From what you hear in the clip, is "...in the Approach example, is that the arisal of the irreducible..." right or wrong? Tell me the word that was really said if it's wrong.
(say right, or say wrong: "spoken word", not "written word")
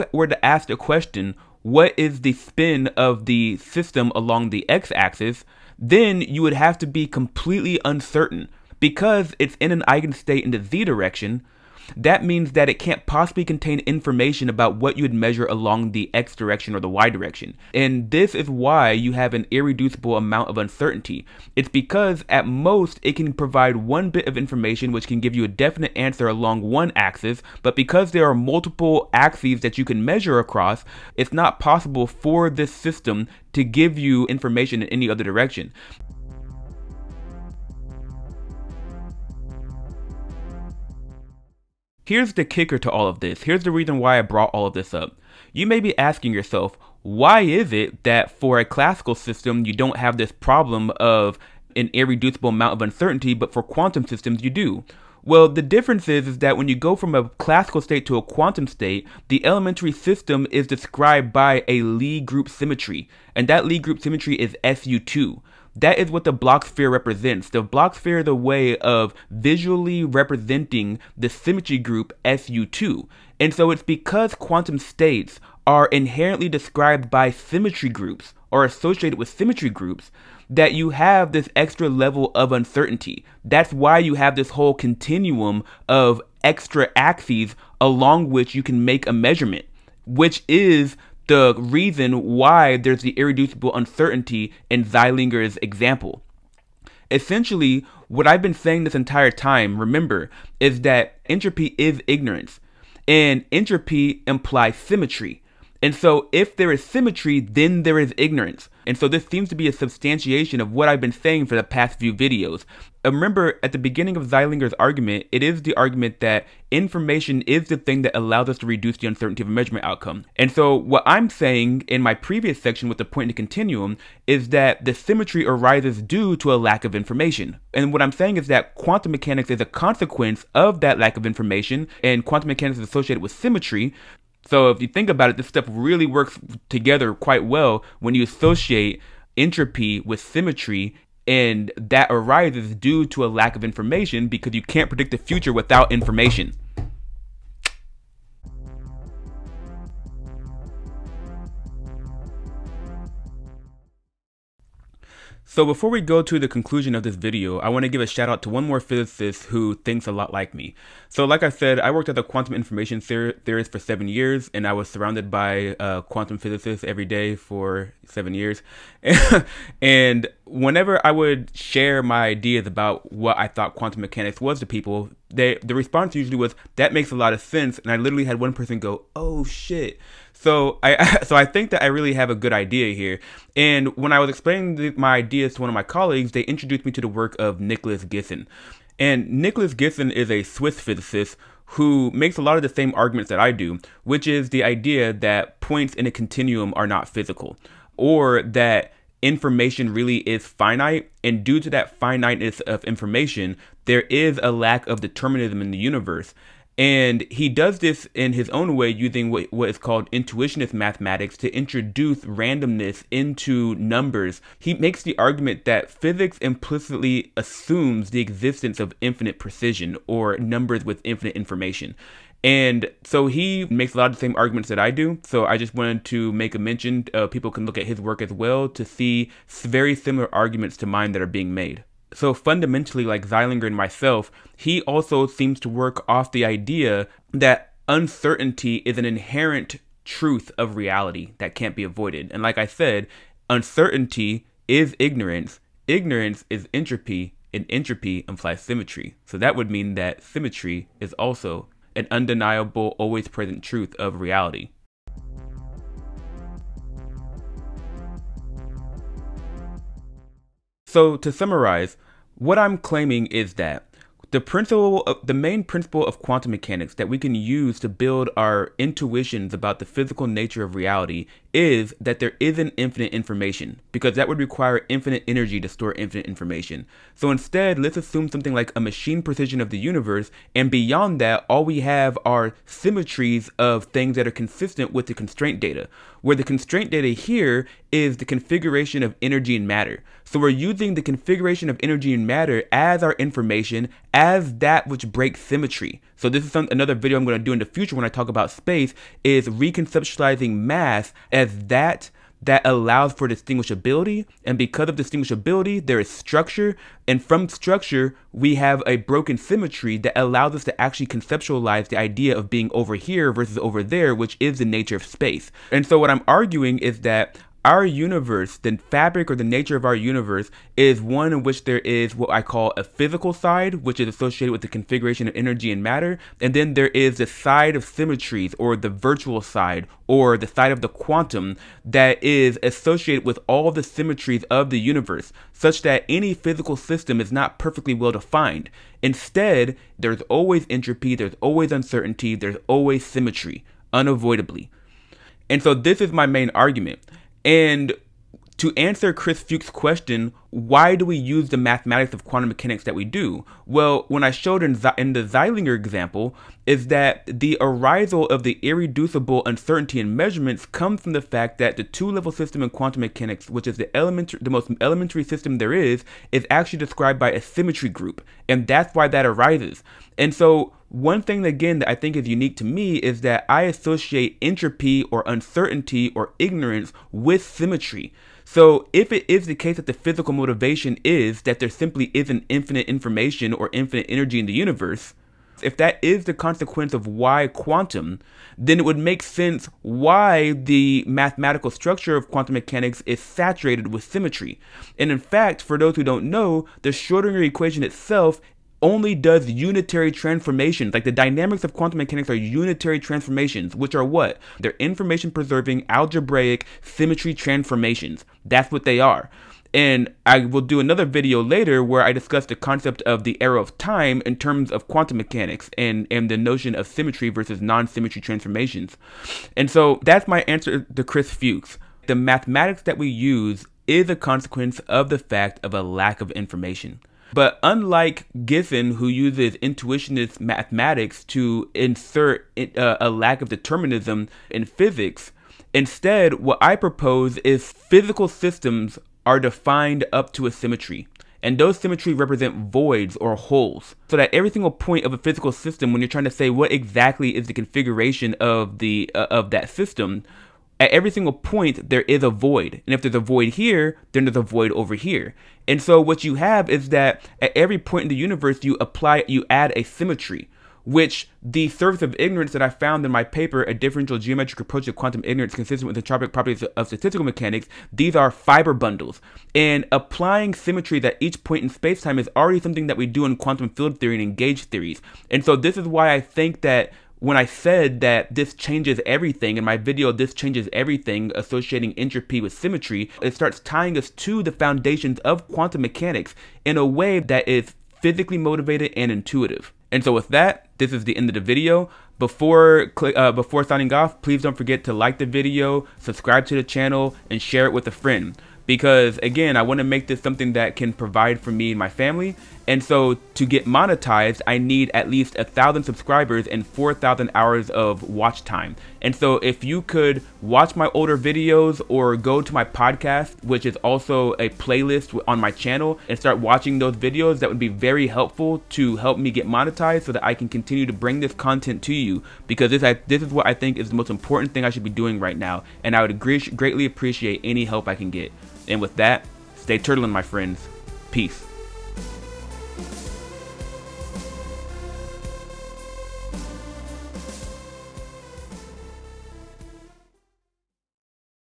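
wrong: "Zeilinger", not "Approach".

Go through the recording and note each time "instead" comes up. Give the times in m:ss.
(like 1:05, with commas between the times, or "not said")
4:37, 5:39, 7:15.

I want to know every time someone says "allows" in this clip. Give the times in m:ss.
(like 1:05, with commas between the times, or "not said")
1:58, 5:02, 5:10.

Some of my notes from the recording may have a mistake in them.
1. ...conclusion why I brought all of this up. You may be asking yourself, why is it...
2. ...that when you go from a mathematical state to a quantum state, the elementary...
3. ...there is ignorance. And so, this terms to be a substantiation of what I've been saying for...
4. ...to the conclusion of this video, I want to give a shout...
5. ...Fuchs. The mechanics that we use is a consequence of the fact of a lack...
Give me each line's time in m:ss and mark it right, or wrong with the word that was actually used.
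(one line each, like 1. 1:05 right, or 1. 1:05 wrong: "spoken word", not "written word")
1. 0:43 wrong: "reason", not "conclusion"
2. 0:56 wrong: "classical", not "mathematical"
3. 1:47 wrong: "seems", not "terms"
4. 2:36 right
5. 7:01 wrong: "mathematics", not "mechanics".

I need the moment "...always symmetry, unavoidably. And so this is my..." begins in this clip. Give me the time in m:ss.
5:42.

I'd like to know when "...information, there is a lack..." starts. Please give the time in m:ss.
3:22.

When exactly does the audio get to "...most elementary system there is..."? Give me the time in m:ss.
6:04.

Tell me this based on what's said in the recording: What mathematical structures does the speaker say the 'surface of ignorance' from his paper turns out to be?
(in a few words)
fiber bundles.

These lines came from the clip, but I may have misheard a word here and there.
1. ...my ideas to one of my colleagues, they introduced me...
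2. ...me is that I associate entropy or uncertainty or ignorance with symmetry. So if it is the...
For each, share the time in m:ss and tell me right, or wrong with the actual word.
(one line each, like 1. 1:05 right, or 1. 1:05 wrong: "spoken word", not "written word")
1. 3:04 right
2. 6:12 right.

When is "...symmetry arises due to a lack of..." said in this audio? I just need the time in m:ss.
2:04.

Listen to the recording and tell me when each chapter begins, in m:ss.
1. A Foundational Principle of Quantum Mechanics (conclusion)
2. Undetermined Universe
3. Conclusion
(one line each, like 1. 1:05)
1. 0:35
2. 2:27
3. 4:14.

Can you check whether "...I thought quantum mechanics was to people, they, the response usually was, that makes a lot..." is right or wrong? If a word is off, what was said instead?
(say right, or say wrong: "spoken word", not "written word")
right.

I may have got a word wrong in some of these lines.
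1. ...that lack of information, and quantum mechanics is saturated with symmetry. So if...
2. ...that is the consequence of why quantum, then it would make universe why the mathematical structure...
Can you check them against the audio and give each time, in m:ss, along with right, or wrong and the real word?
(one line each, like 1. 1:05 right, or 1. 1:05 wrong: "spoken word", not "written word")
1. 2:10 wrong: "associated", not "saturated"
2. 6:25 wrong: "sense", not "universe".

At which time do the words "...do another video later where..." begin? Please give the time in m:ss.
6:50.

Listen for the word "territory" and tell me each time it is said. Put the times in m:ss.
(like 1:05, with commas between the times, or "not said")
not said.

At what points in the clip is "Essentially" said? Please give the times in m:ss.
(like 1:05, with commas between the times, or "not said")
1:37.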